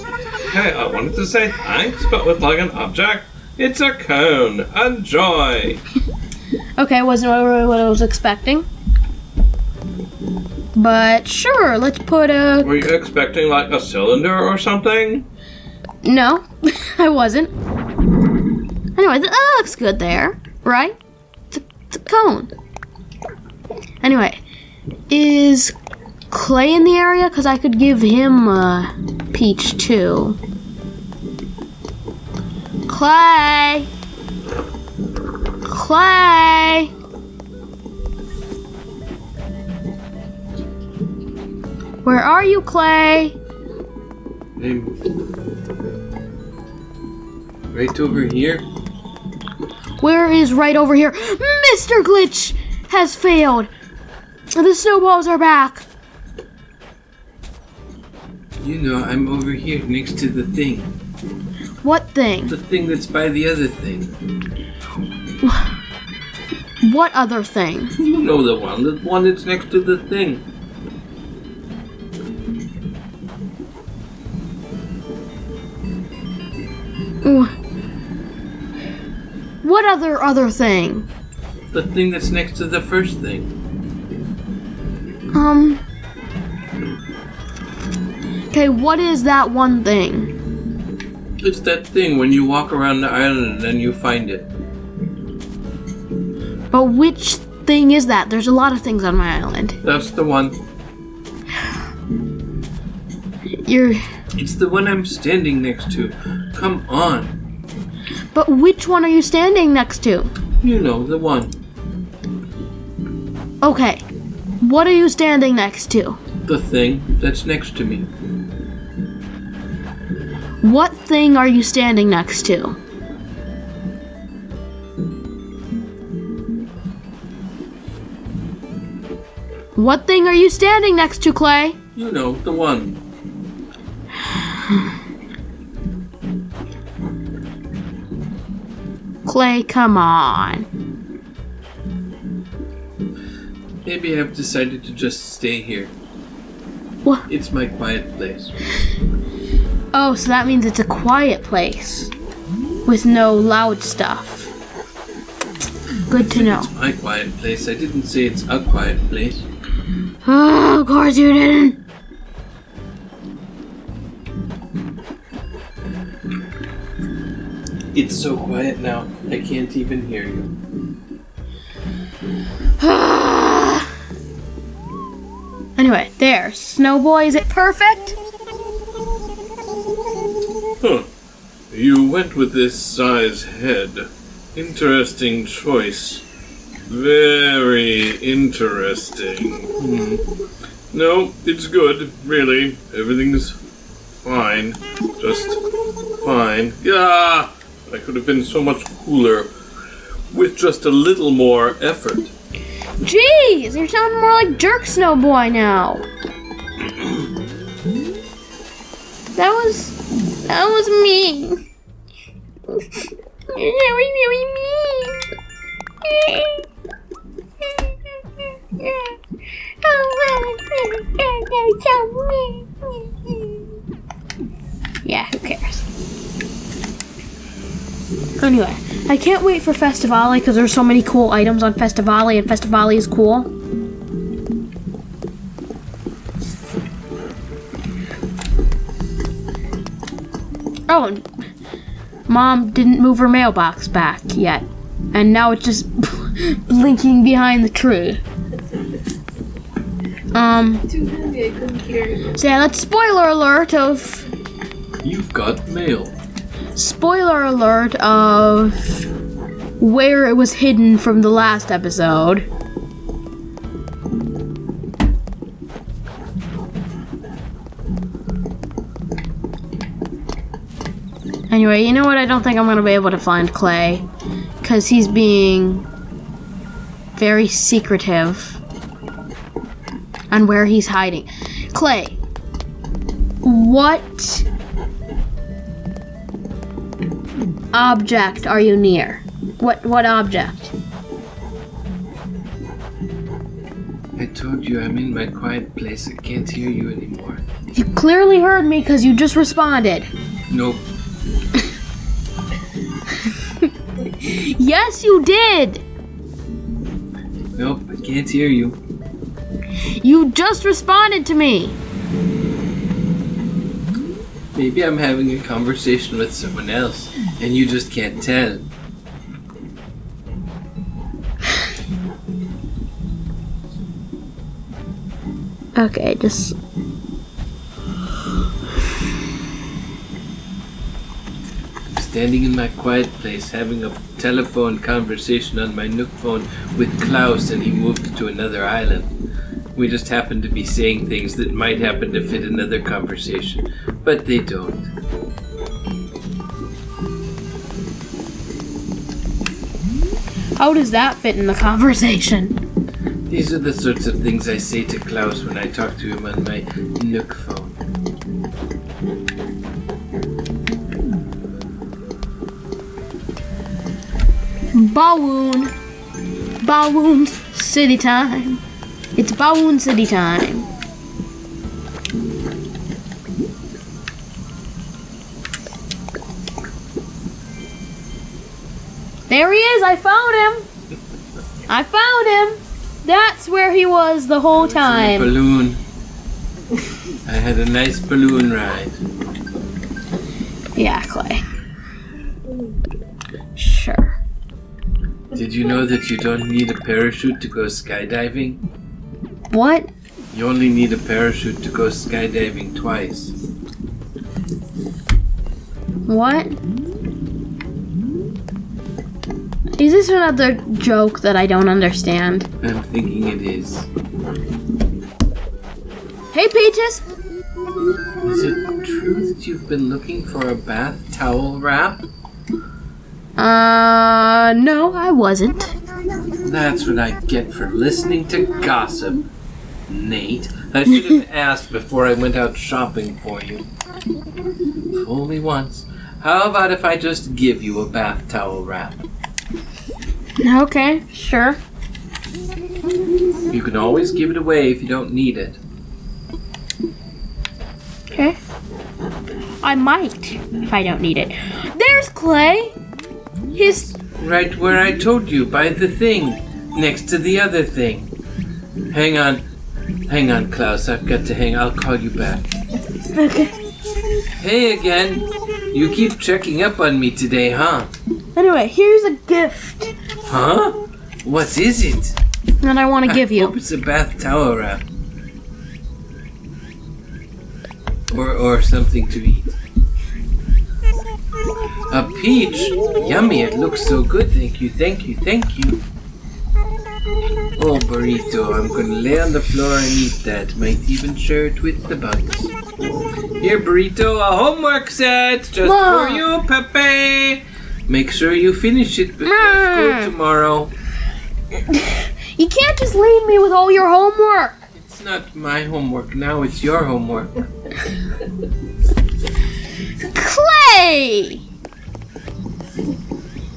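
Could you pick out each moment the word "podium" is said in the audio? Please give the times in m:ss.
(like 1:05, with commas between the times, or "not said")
not said.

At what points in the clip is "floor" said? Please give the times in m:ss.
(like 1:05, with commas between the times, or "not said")
8:09.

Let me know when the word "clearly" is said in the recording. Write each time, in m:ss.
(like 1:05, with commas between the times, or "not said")
4:57.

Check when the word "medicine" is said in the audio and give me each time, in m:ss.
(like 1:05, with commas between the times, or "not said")
not said.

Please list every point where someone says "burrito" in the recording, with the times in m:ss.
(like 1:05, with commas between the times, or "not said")
8:07, 8:13.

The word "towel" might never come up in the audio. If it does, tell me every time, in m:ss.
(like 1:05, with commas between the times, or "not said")
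7:01, 7:18, 7:54.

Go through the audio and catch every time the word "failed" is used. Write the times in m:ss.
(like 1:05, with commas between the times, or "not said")
0:53.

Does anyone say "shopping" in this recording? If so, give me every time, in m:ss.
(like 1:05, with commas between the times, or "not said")
7:12.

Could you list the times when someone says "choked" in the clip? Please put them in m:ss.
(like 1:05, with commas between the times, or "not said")
not said.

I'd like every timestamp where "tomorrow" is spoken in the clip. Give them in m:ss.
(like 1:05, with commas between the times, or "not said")
8:20.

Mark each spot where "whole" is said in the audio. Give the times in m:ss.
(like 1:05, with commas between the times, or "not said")
6:24.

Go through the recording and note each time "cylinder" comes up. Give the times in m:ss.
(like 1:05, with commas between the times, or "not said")
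0:13.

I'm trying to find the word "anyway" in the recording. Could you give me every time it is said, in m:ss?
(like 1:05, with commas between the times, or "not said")
0:18, 0:24, 2:55, 3:48, 4:31, 7:48.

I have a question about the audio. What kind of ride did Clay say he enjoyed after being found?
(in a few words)
Balloon ride.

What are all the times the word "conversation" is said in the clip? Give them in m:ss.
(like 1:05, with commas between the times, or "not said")
5:15, 5:34, 5:42, 5:51.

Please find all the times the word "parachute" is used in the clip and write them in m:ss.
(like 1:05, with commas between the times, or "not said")
6:36, 6:40.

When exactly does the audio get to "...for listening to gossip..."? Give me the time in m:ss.
7:07.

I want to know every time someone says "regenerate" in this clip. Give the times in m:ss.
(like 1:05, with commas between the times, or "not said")
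not said.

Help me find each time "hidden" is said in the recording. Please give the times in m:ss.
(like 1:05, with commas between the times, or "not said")
4:20.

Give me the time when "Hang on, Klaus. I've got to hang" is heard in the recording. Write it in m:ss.
7:40.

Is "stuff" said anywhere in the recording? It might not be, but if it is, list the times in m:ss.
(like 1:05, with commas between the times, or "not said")
2:33.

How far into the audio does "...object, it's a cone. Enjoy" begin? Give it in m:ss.
0:02.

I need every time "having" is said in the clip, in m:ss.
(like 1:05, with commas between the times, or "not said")
5:14, 5:33.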